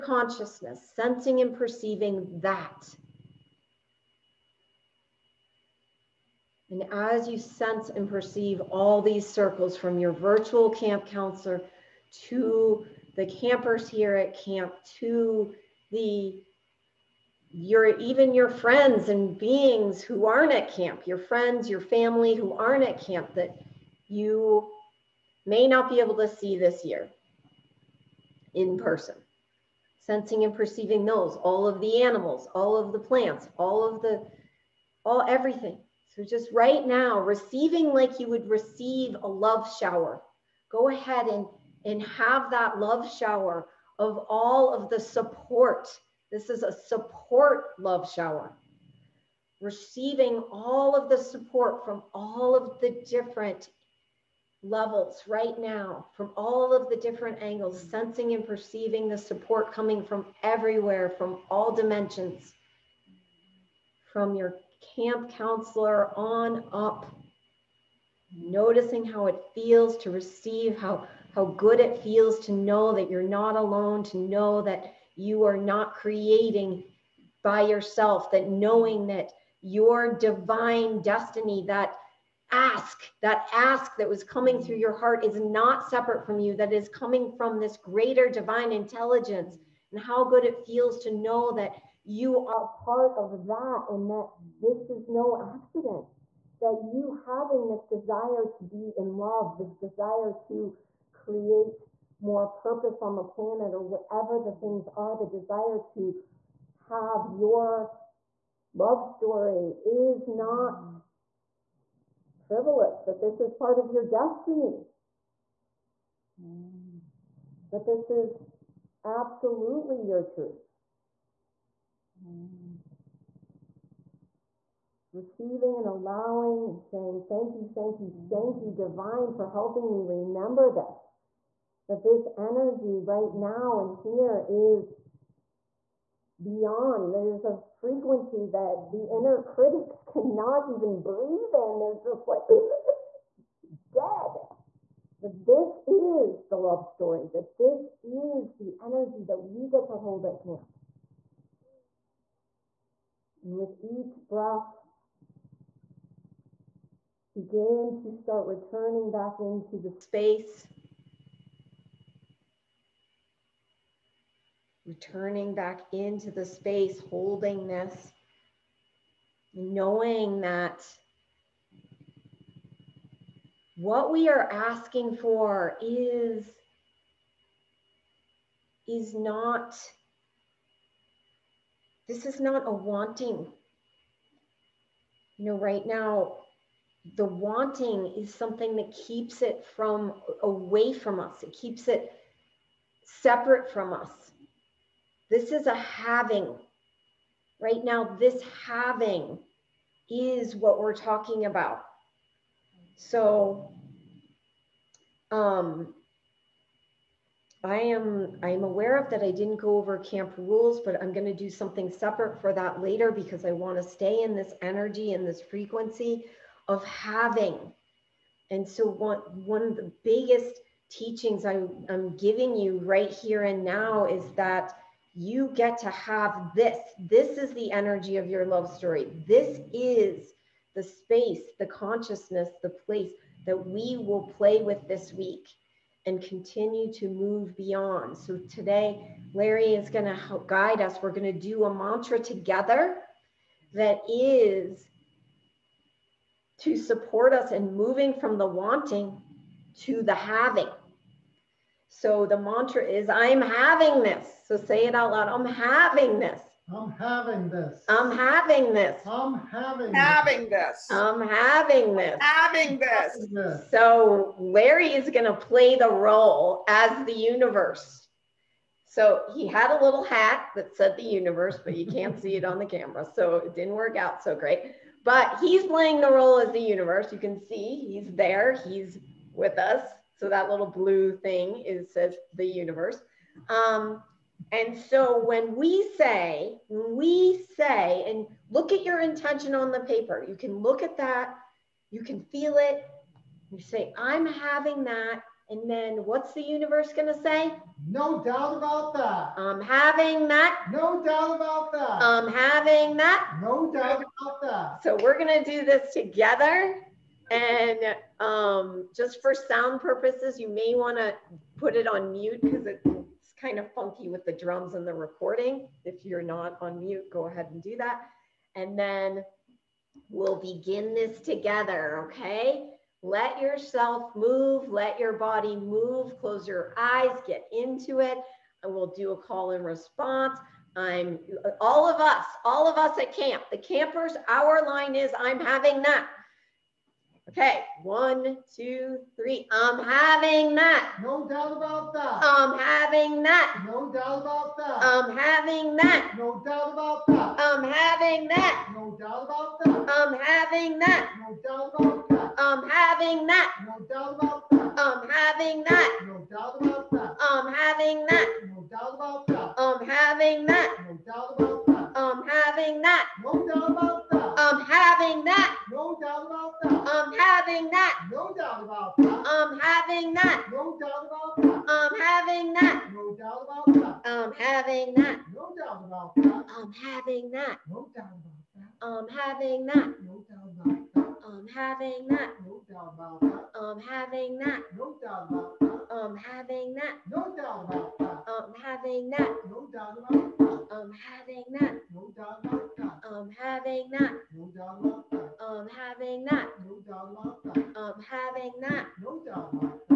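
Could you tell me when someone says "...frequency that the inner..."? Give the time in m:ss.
2:17.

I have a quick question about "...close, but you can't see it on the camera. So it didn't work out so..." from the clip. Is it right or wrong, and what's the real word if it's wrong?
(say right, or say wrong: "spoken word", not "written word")
wrong: "universe", not "close".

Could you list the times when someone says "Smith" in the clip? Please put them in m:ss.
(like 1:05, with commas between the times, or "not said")
not said.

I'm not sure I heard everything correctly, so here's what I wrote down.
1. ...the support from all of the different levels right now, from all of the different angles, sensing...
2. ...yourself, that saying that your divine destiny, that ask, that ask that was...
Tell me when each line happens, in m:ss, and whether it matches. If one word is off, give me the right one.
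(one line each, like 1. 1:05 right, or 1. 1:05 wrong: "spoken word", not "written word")
1. 0:51 right
2. 1:17 wrong: "knowing", not "saying".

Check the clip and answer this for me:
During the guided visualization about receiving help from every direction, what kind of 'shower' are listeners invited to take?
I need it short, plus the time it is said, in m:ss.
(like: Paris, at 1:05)
support love shower, at 0:46.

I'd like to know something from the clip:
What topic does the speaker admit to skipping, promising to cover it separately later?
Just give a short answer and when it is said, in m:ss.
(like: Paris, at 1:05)
camp rules, at 3:29.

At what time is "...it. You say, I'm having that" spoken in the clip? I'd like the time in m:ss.
4:52.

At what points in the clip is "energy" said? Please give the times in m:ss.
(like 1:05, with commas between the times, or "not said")
2:12, 2:28, 3:34, 3:47.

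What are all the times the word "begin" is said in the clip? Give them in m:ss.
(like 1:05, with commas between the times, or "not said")
2:37, 5:20.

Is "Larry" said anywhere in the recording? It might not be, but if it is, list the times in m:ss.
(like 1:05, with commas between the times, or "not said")
3:59, 4:24.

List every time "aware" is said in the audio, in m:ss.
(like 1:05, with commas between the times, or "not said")
3:28.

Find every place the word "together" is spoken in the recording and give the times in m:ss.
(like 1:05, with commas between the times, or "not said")
4:02, 5:05, 5:21.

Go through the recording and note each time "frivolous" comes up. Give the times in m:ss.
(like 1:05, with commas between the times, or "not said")
1:52.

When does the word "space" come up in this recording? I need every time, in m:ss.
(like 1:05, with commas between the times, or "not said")
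2:39, 2:46, 3:50.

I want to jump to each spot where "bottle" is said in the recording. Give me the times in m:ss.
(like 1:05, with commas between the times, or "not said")
not said.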